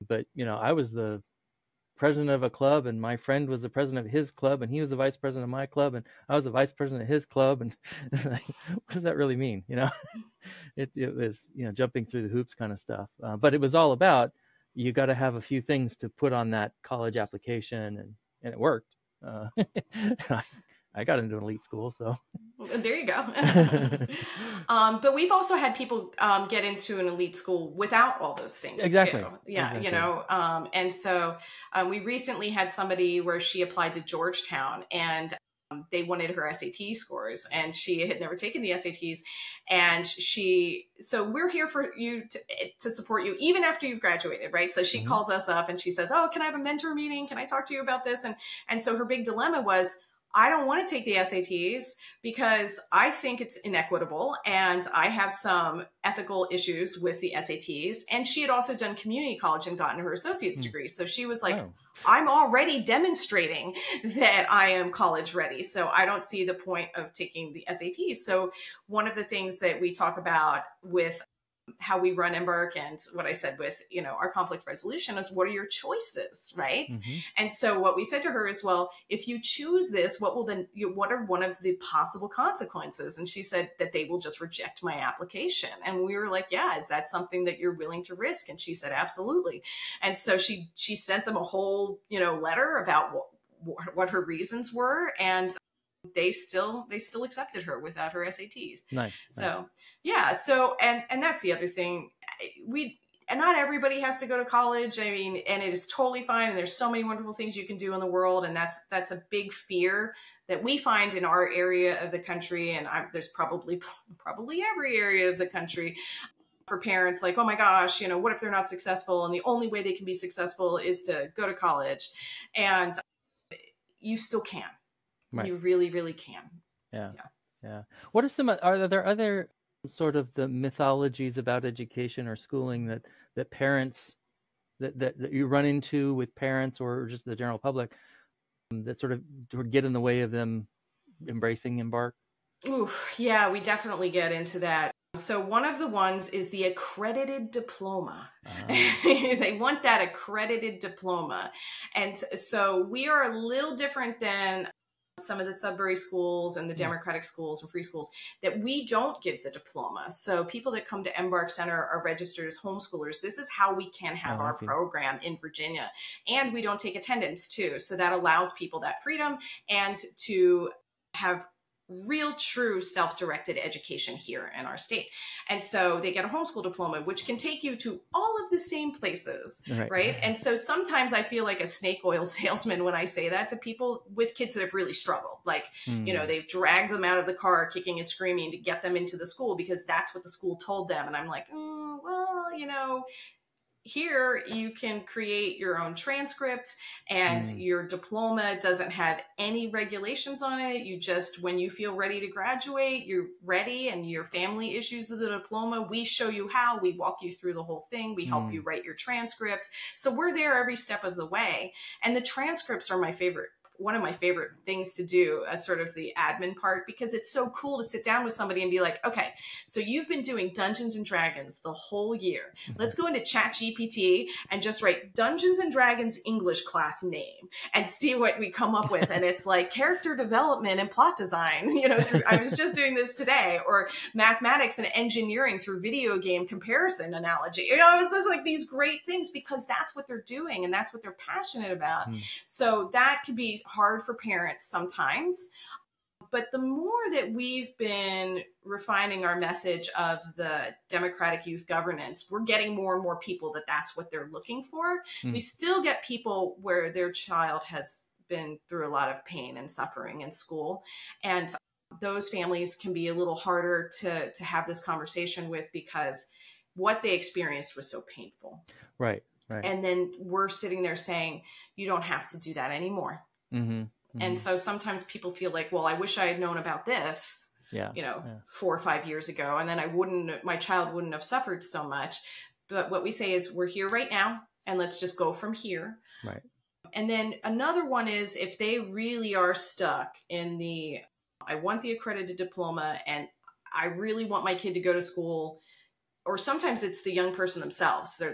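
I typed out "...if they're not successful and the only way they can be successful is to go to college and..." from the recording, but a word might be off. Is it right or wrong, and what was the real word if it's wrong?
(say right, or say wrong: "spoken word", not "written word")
right.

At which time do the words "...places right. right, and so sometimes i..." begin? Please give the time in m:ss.
2:58.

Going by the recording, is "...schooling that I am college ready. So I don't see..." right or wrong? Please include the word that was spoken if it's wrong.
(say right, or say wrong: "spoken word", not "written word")
wrong: "demonstrating", not "schooling".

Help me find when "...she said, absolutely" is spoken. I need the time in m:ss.
1:28.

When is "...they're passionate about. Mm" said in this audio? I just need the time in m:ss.
4:01.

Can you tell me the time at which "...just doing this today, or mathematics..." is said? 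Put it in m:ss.
3:52.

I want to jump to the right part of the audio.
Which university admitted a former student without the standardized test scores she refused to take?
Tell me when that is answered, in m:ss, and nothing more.
0:34.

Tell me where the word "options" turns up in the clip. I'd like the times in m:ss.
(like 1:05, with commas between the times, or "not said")
not said.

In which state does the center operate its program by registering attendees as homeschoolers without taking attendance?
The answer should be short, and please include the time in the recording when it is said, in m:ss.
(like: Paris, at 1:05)
Virginia, at 2:45.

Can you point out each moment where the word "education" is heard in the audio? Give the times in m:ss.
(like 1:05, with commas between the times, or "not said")
2:11, 2:53.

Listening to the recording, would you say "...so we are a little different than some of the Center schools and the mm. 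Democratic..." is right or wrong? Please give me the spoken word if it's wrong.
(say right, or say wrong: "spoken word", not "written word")
wrong: "Sudbury", not "Center".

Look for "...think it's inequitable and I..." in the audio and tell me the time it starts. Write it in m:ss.
0:53.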